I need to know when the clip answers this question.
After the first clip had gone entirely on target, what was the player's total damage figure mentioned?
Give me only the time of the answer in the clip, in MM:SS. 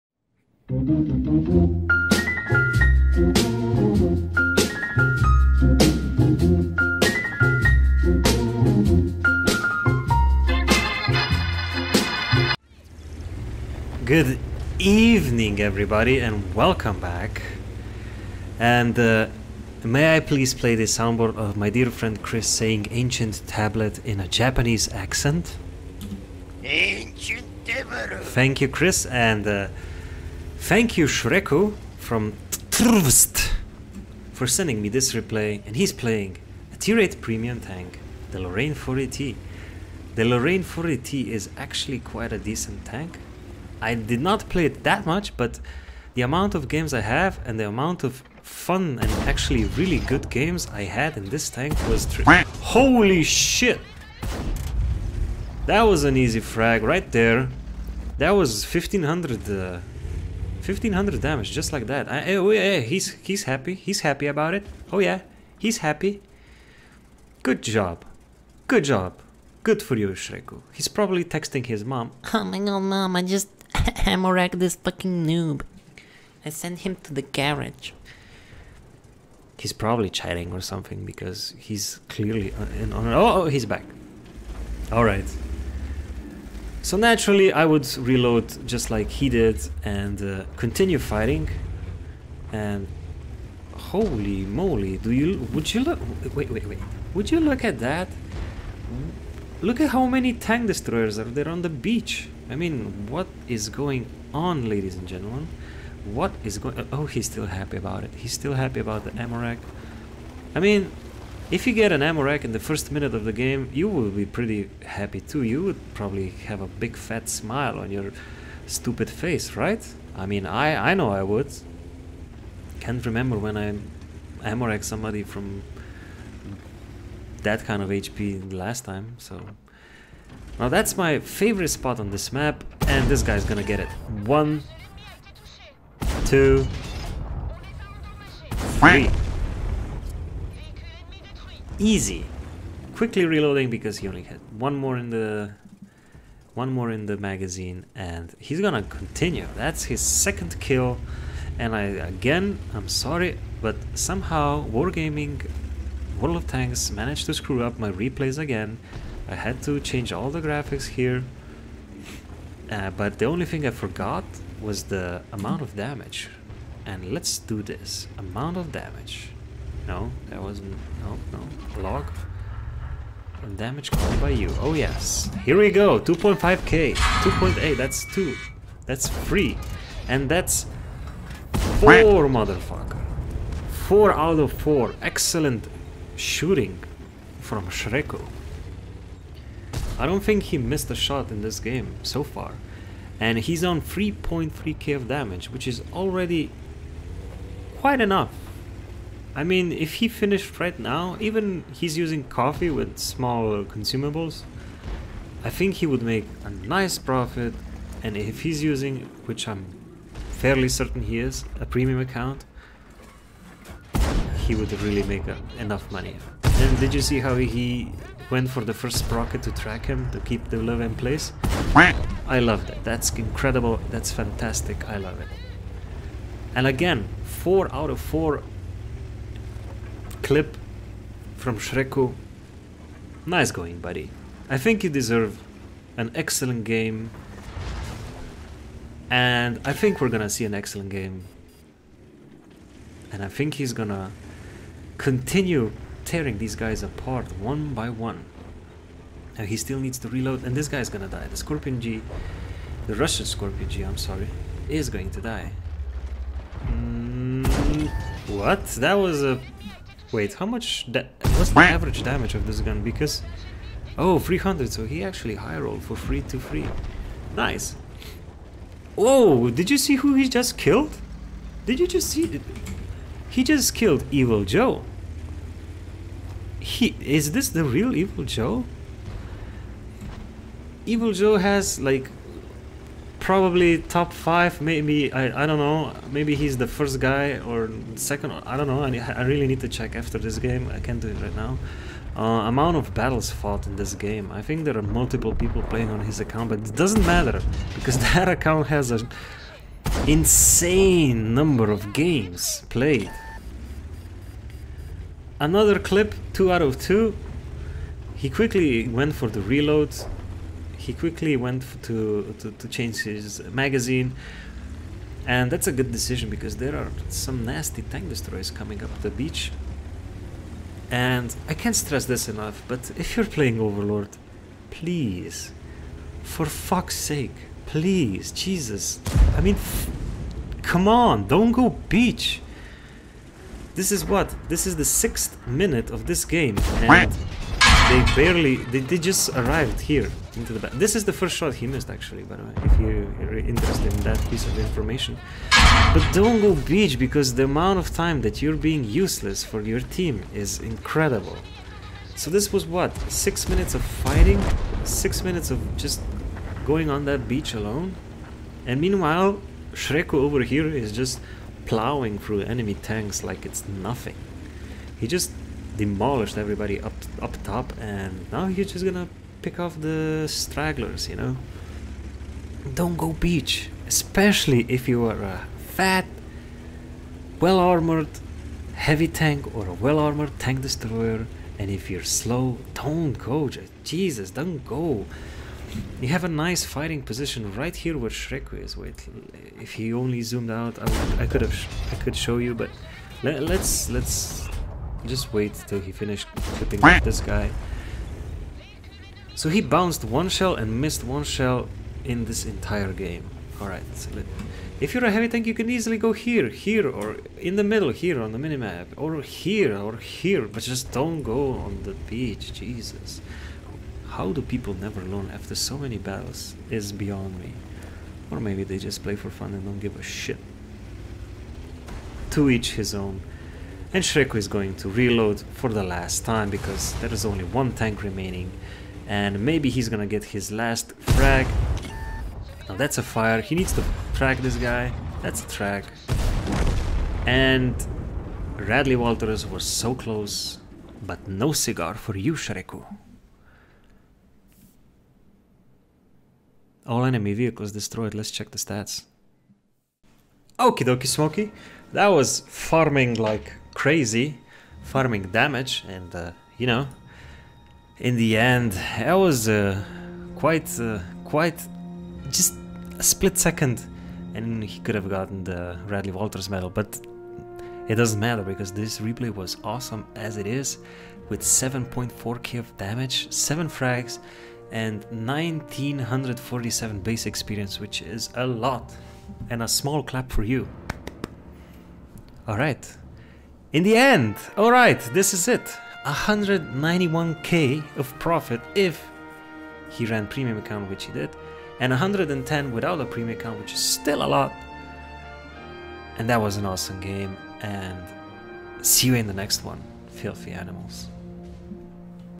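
03:13.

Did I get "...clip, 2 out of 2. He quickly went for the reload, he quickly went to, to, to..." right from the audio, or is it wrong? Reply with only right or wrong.
right.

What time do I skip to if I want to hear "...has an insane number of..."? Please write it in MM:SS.
04:58.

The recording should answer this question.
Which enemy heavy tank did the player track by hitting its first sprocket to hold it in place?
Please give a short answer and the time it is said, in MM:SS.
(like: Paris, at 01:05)
Löwe, at 03:40.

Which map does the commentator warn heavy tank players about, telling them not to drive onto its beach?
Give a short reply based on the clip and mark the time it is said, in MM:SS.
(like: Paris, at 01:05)
Overlord, at 05:23.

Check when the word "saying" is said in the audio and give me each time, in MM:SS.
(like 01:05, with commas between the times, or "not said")
00:22.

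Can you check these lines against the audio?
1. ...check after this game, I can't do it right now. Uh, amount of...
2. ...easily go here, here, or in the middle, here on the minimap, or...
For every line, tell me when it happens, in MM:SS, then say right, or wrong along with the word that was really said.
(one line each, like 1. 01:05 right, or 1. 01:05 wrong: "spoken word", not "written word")
1. 04:49 right
2. 06:45 right.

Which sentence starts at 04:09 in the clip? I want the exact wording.
Now he still needs to reload, and this guy's gonna die.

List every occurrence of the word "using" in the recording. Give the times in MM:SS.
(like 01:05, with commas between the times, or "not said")
03:21, 03:28.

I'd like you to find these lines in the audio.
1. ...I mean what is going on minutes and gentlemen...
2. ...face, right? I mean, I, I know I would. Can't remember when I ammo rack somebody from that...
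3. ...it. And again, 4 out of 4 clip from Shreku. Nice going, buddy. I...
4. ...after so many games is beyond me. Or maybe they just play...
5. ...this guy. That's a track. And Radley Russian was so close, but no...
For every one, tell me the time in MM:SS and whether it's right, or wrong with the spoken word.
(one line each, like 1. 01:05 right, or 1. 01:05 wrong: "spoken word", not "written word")
1. 01:42 wrong: "ladies", not "minutes"
2. 01:59 right
3. 03:45 right
4. 06:55 wrong: "battles", not "games"
5. 07:14 wrong: "Walters", not "Russian".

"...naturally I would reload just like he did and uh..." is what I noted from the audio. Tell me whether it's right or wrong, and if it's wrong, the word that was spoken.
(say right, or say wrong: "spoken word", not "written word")
right.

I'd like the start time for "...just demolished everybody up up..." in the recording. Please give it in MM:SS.
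06:05.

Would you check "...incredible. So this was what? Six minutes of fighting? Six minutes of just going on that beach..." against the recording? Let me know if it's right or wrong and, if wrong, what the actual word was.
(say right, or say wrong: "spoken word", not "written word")
right.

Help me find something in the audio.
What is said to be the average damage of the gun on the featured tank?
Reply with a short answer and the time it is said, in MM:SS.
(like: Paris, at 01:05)
300, at 04:24.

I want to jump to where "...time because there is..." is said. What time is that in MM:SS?
07:06.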